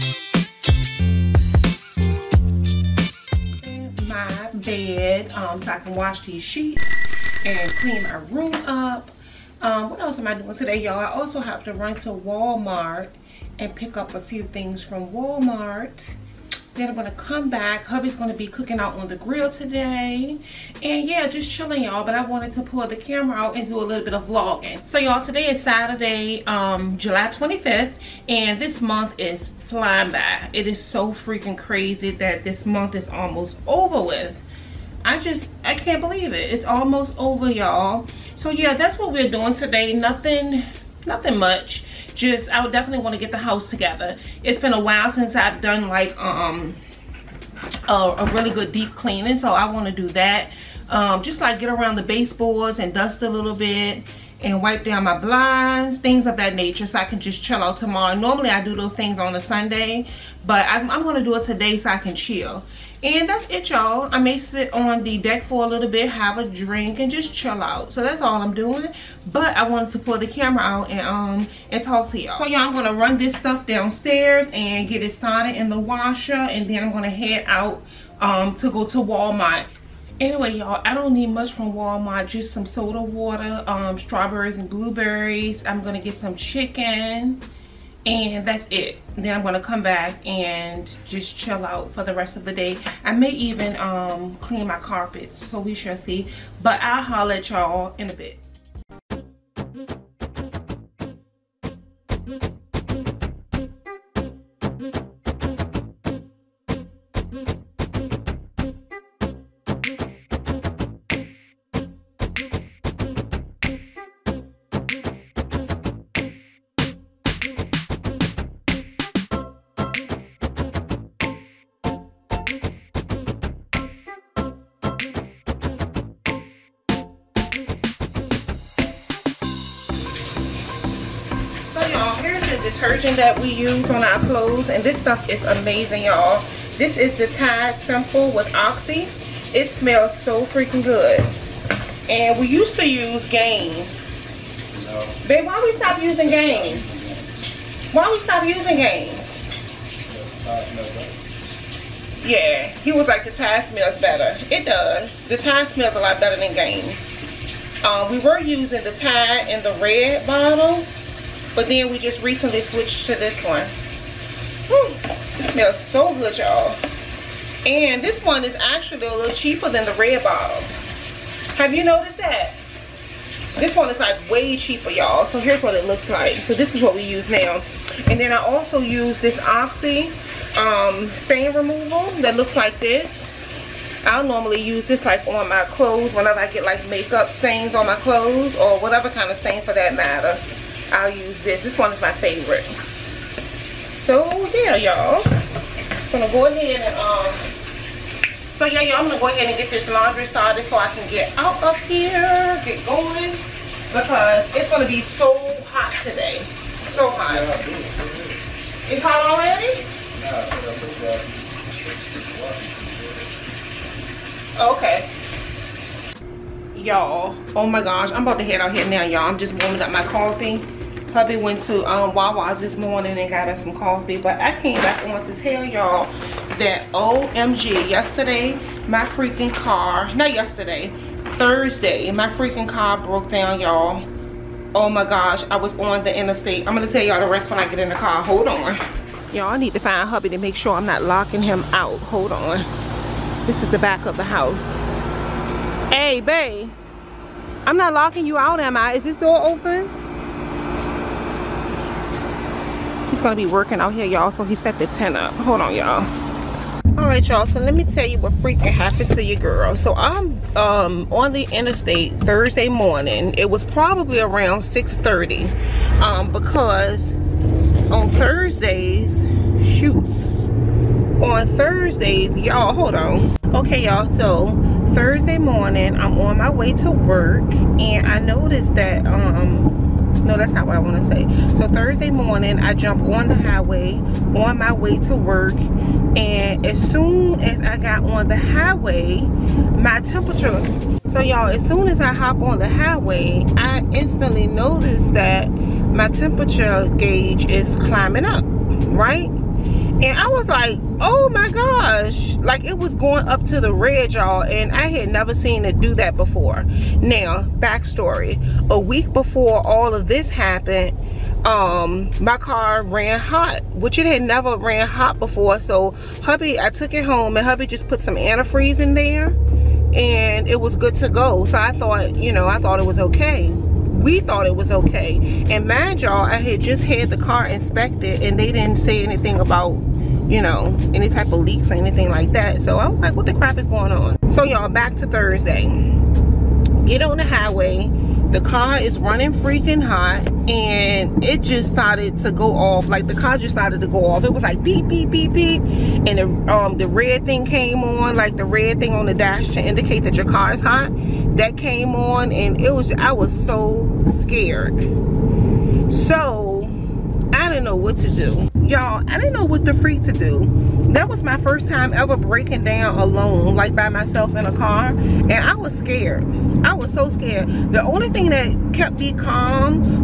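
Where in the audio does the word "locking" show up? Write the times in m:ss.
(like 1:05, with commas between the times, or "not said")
4:01, 4:07.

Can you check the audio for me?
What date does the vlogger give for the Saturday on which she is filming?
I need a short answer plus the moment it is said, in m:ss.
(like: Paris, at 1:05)
July 25th, at 0:26.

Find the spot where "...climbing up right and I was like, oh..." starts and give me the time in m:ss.
4:57.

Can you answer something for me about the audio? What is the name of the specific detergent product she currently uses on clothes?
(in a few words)
Tide Simple with Oxy.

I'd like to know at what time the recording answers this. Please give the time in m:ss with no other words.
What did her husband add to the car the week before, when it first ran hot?
5:18.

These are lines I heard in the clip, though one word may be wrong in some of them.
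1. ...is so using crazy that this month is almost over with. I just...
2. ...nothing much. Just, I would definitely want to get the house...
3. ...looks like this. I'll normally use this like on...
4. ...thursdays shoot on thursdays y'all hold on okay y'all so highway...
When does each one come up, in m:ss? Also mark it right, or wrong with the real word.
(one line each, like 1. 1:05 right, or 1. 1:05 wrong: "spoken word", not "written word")
1. 0:30 wrong: "freaking", not "using"
2. 0:41 right
3. 3:02 right
4. 4:28 wrong: "thursday", not "highway".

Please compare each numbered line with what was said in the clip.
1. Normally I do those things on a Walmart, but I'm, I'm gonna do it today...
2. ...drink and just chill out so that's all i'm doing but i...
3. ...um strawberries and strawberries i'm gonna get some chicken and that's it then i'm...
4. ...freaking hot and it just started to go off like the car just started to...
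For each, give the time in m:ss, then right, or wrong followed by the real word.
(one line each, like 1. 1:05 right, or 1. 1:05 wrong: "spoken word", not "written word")
1. 0:58 wrong: "Sunday", not "Walmart"
2. 1:06 right
3. 1:23 wrong: "blueberries", not "strawberries"
4. 5:39 right.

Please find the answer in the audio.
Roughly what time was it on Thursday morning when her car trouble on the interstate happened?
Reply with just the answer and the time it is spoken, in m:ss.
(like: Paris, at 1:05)
6:30, at 4:24.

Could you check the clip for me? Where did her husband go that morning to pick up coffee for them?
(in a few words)
Wawa's.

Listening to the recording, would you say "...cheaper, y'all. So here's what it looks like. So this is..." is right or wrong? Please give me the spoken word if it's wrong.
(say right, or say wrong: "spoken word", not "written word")
right.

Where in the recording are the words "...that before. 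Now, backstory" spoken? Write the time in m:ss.
5:05.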